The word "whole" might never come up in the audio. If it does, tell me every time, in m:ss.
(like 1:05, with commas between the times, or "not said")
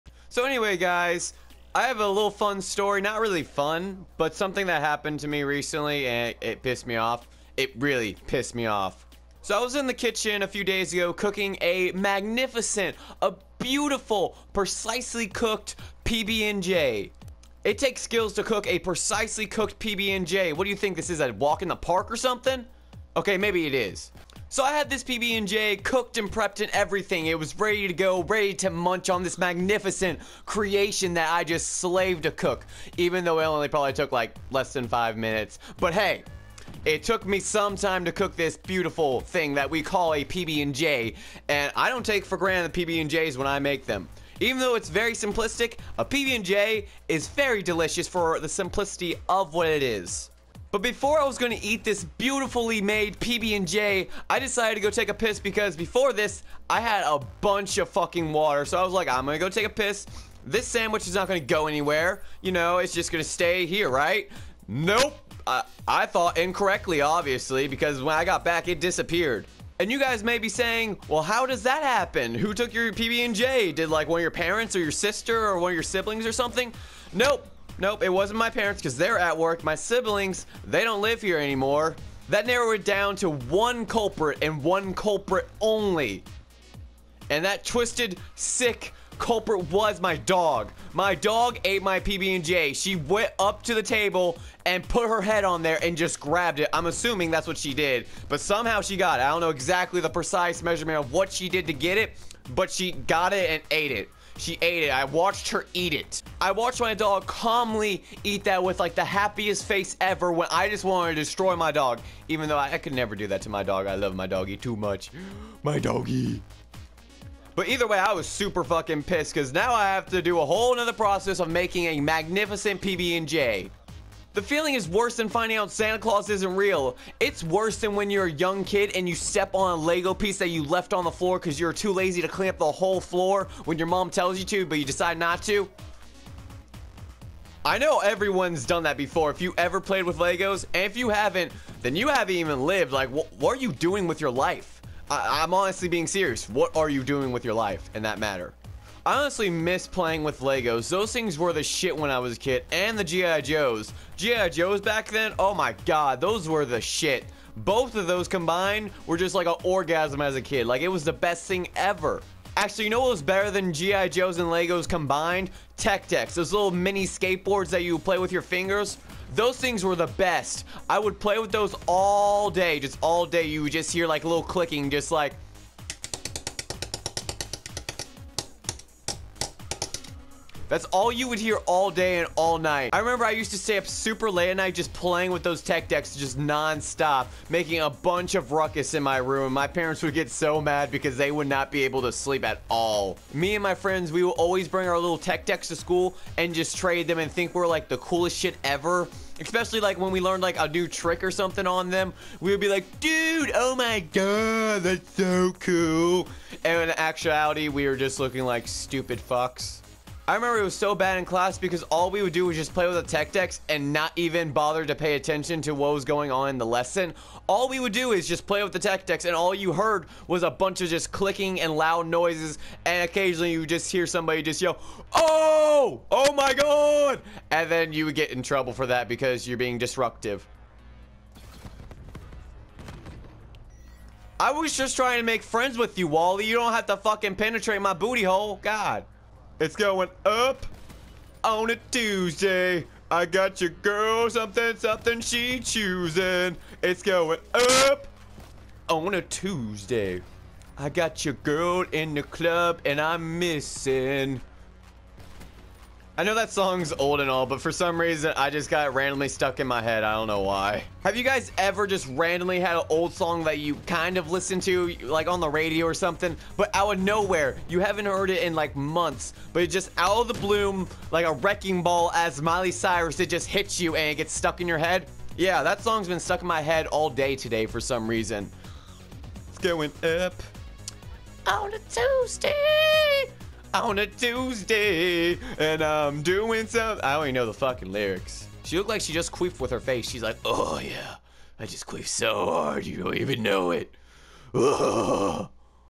2:00, 2:12.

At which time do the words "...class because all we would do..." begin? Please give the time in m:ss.
3:31.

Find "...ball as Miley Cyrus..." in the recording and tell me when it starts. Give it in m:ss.
4:31.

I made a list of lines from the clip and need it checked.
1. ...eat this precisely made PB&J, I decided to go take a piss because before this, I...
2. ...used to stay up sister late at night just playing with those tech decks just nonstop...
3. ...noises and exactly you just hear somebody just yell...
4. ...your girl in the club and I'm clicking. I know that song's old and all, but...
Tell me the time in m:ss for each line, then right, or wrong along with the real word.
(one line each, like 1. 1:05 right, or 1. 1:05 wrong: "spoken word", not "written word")
1. 0:51 wrong: "beautifully", not "precisely"
2. 3:03 wrong: "super", not "sister"
3. 3:42 wrong: "occasionally", not "exactly"
4. 4:11 wrong: "missing", not "clicking".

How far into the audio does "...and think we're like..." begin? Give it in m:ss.
3:17.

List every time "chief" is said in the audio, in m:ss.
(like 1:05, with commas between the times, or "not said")
not said.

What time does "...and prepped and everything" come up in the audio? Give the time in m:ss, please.
0:26.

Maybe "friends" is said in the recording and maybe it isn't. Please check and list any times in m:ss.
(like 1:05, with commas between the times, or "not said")
3:13, 3:55.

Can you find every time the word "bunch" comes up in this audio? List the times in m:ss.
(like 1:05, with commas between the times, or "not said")
0:57, 3:07, 3:40.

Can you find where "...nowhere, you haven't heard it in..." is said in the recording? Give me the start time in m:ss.
4:27.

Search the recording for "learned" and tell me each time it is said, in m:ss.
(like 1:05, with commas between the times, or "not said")
3:20.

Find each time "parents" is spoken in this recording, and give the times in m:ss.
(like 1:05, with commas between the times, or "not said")
1:14, 1:18, 3:09.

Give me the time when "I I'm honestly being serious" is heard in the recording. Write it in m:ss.
2:25.